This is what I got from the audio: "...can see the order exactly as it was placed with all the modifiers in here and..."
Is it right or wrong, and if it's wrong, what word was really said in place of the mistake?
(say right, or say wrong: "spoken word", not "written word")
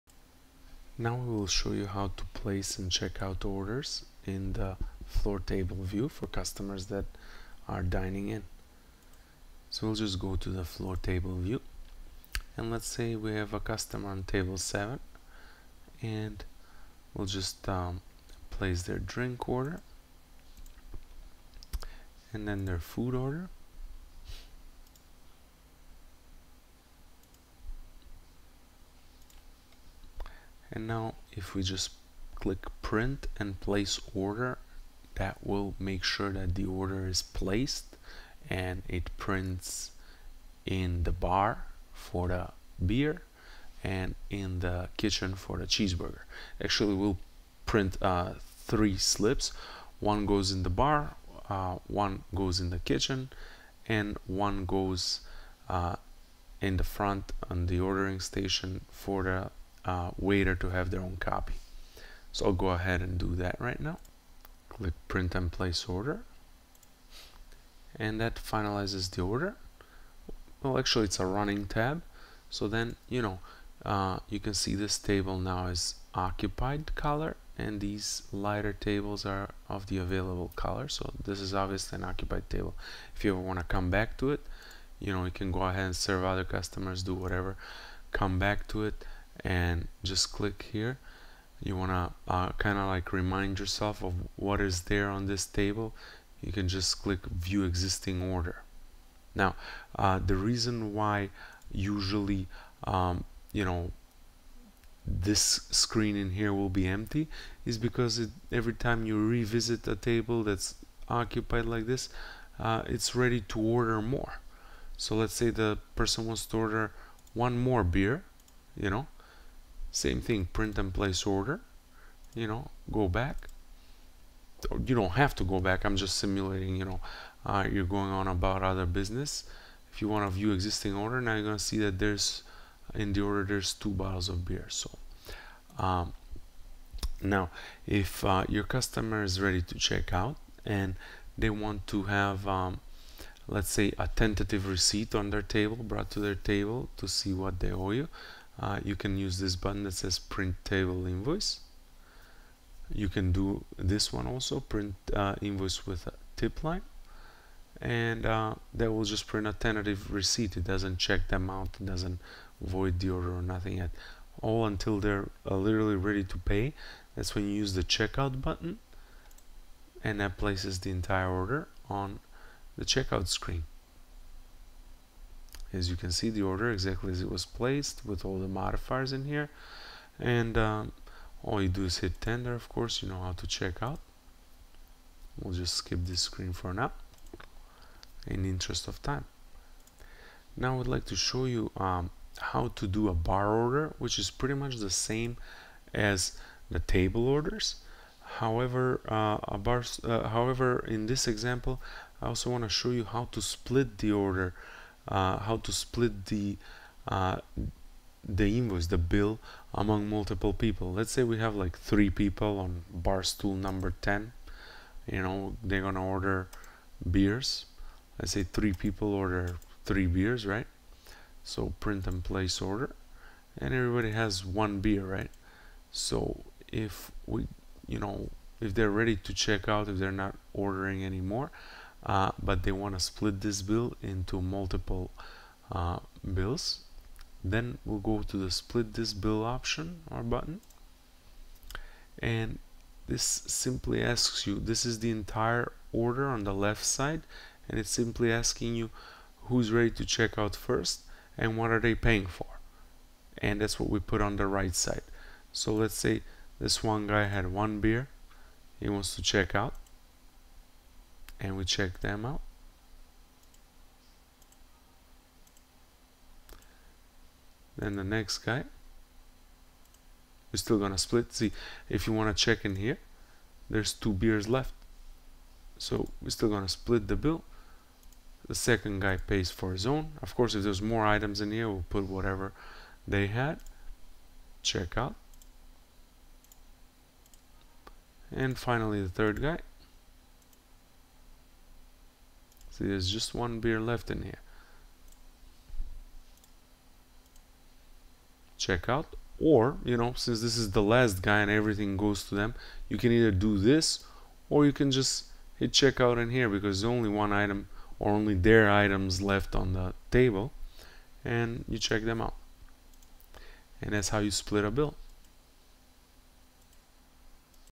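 right.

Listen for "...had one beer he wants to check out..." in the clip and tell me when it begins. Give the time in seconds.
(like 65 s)
257 s.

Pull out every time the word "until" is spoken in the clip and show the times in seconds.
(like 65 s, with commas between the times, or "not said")
164 s.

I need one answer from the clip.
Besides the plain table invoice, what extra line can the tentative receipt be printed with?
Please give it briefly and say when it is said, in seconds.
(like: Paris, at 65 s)
tip line, at 156 s.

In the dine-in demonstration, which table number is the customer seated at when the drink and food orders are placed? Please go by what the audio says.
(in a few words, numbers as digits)
7.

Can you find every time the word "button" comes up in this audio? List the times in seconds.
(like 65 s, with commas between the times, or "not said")
149 s, 168 s, 240 s.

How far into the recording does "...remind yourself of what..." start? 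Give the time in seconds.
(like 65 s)
93 s.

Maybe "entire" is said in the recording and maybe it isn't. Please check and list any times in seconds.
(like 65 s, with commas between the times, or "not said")
170 s, 245 s.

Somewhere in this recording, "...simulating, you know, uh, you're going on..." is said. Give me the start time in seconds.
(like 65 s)
126 s.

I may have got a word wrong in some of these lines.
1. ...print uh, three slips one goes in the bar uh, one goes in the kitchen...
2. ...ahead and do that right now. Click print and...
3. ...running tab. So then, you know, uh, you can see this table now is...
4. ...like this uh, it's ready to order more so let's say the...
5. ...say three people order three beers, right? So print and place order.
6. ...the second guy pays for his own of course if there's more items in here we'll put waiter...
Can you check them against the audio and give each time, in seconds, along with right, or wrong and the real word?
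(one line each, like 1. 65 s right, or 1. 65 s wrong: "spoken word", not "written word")
1. 47 s right
2. 62 s right
3. 71 s right
4. 111 s right
5. 218 s right
6. 278 s wrong: "whatever", not "waiter".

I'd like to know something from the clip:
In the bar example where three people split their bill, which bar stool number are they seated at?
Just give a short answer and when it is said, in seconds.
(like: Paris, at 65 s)
10, at 213 s.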